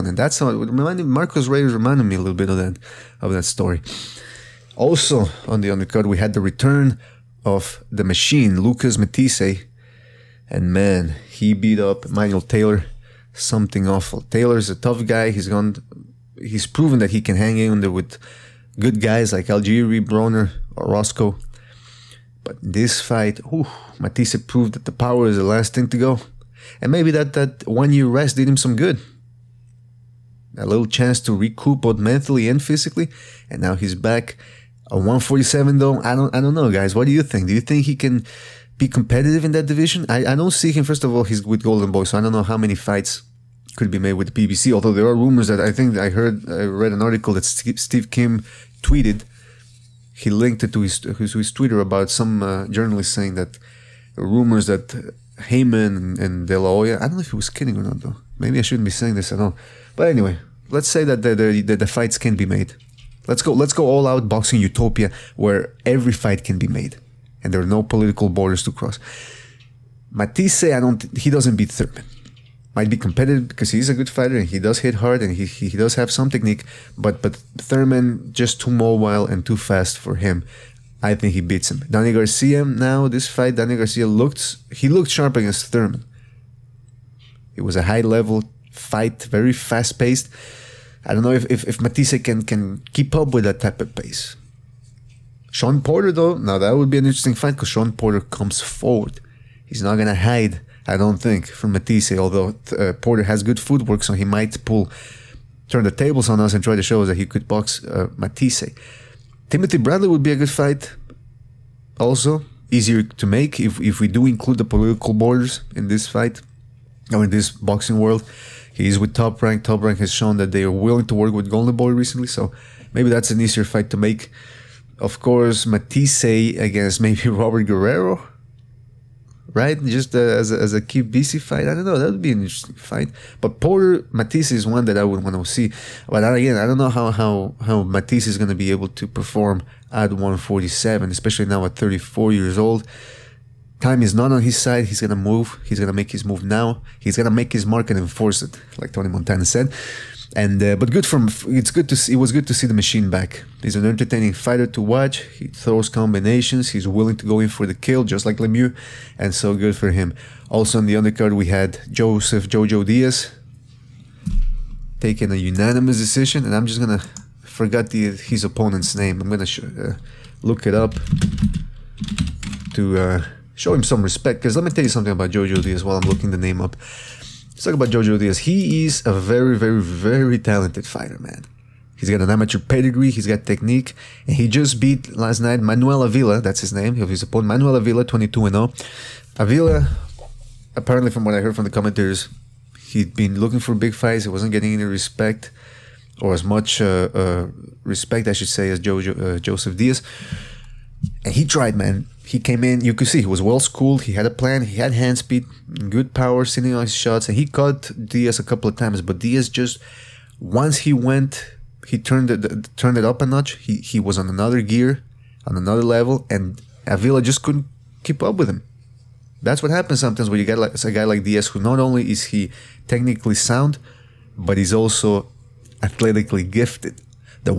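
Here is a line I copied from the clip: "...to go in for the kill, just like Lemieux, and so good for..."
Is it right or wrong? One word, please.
right.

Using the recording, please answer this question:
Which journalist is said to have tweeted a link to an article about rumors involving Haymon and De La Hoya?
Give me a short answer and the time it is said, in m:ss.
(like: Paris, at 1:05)
Steve Kim, at 0:47.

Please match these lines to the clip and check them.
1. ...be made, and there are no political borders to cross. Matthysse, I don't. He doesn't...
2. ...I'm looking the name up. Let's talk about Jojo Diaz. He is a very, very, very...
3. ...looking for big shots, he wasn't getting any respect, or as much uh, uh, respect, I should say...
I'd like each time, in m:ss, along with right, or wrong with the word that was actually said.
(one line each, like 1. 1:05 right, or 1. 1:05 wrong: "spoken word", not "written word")
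1. 1:06 right
2. 2:55 right
3. 3:13 wrong: "fights", not "shots".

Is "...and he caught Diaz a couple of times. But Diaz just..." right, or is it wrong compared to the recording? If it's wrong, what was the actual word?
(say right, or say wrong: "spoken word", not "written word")
right.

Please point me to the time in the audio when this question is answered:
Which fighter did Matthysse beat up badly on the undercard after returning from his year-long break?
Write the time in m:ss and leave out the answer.
0:12.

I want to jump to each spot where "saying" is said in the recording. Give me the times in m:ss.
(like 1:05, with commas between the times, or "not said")
0:53, 0:59.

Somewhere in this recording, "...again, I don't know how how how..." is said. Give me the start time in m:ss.
2:16.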